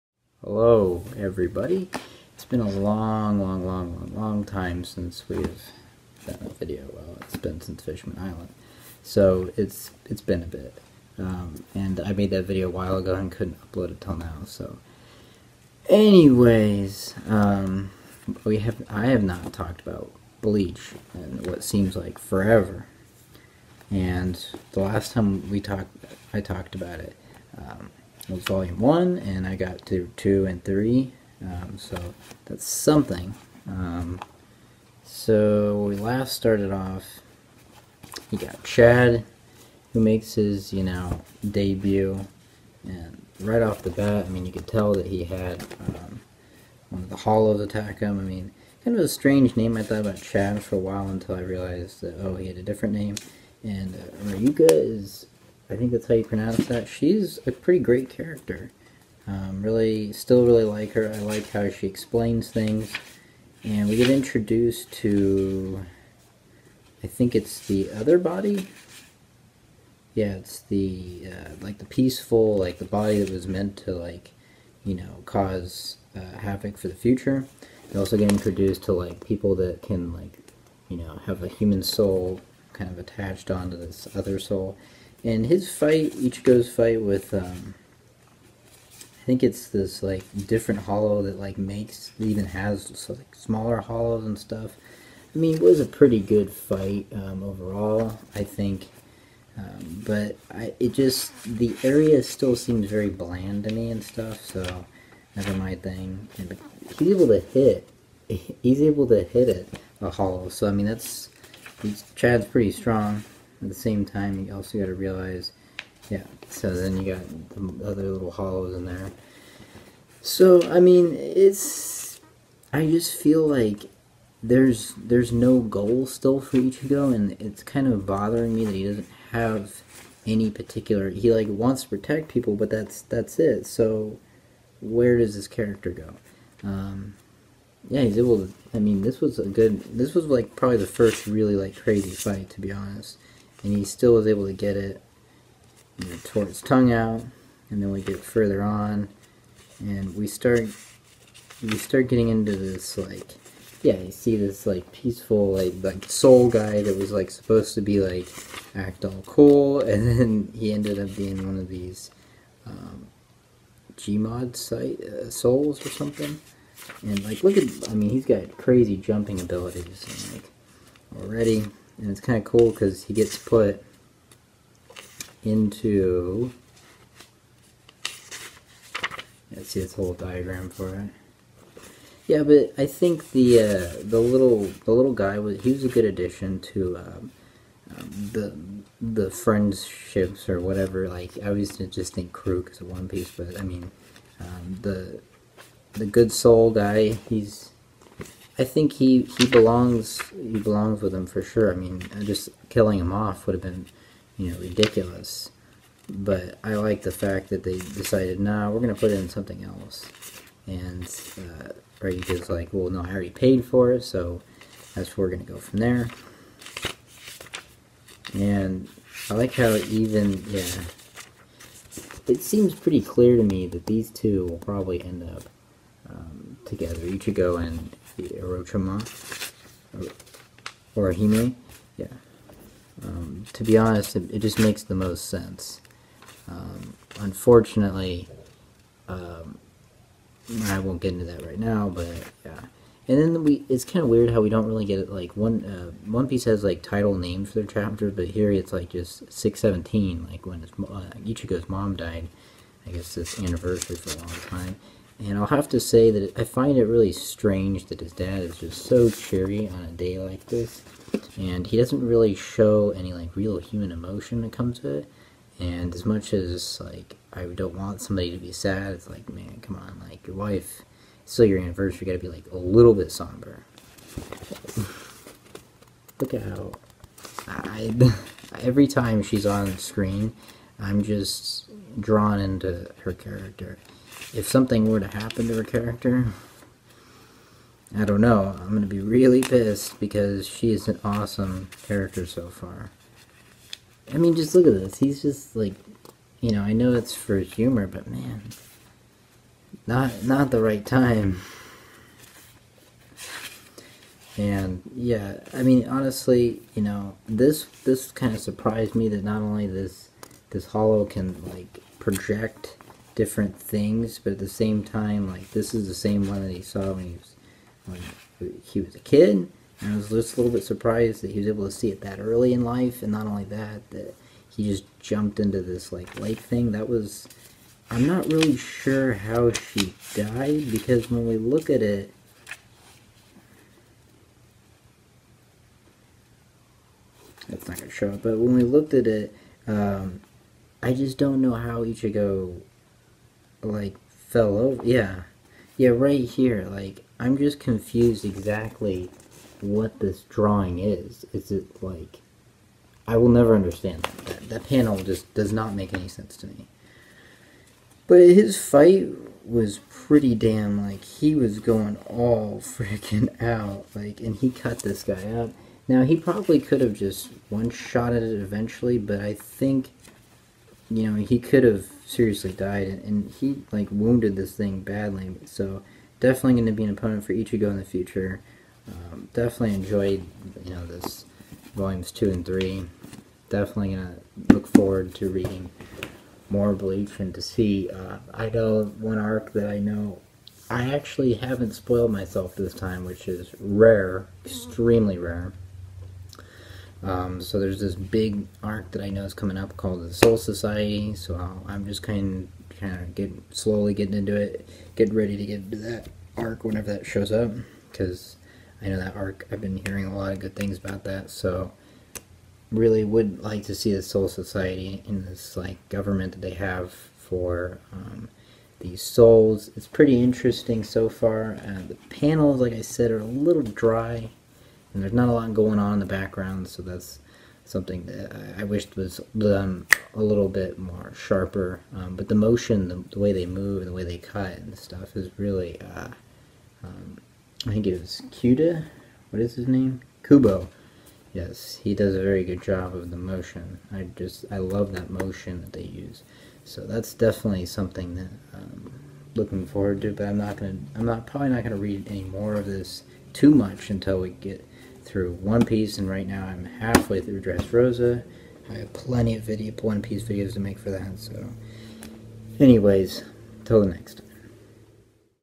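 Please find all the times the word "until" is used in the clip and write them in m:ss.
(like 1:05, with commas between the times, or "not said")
0:51, 7:33.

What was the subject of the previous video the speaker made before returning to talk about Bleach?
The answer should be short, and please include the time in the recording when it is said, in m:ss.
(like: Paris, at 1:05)
Fishman Island, at 0:07.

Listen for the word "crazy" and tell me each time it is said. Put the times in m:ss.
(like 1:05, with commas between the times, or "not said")
2:21, 2:48.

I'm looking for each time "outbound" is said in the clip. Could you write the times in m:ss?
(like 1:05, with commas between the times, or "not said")
not said.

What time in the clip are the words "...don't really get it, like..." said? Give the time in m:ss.
4:04.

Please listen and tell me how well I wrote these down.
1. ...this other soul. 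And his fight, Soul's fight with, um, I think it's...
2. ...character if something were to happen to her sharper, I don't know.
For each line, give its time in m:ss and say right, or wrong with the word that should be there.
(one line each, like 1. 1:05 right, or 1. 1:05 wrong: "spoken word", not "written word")
1. 1:23 wrong: "Ichigo", not "Soul"
2. 4:43 wrong: "character", not "sharper".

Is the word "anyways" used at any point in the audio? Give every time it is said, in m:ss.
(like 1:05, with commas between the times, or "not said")
0:15, 7:42.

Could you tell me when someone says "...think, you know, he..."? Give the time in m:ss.
6:09.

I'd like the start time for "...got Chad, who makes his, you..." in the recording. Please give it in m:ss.
0:38.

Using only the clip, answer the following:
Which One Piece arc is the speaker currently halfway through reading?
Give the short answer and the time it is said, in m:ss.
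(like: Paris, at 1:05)
Dressrosa, at 7:37.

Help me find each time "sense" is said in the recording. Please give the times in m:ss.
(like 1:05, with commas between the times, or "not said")
3:55, 5:56.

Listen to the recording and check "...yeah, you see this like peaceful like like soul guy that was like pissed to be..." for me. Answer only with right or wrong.
wrong.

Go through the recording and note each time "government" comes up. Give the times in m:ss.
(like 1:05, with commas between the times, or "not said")
6:55.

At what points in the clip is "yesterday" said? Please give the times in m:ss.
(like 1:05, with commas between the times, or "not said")
not said.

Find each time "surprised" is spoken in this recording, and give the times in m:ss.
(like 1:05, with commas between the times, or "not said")
5:08, 5:20.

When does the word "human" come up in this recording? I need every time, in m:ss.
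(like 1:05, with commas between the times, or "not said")
1:21, 4:23.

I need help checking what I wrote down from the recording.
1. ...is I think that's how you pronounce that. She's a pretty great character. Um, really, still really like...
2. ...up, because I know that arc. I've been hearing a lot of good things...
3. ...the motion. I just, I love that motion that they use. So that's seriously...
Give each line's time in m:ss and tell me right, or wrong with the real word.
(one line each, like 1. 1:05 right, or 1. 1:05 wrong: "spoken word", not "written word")
1. 0:54 right
2. 6:47 right
3. 7:23 wrong: "definitely", not "seriously".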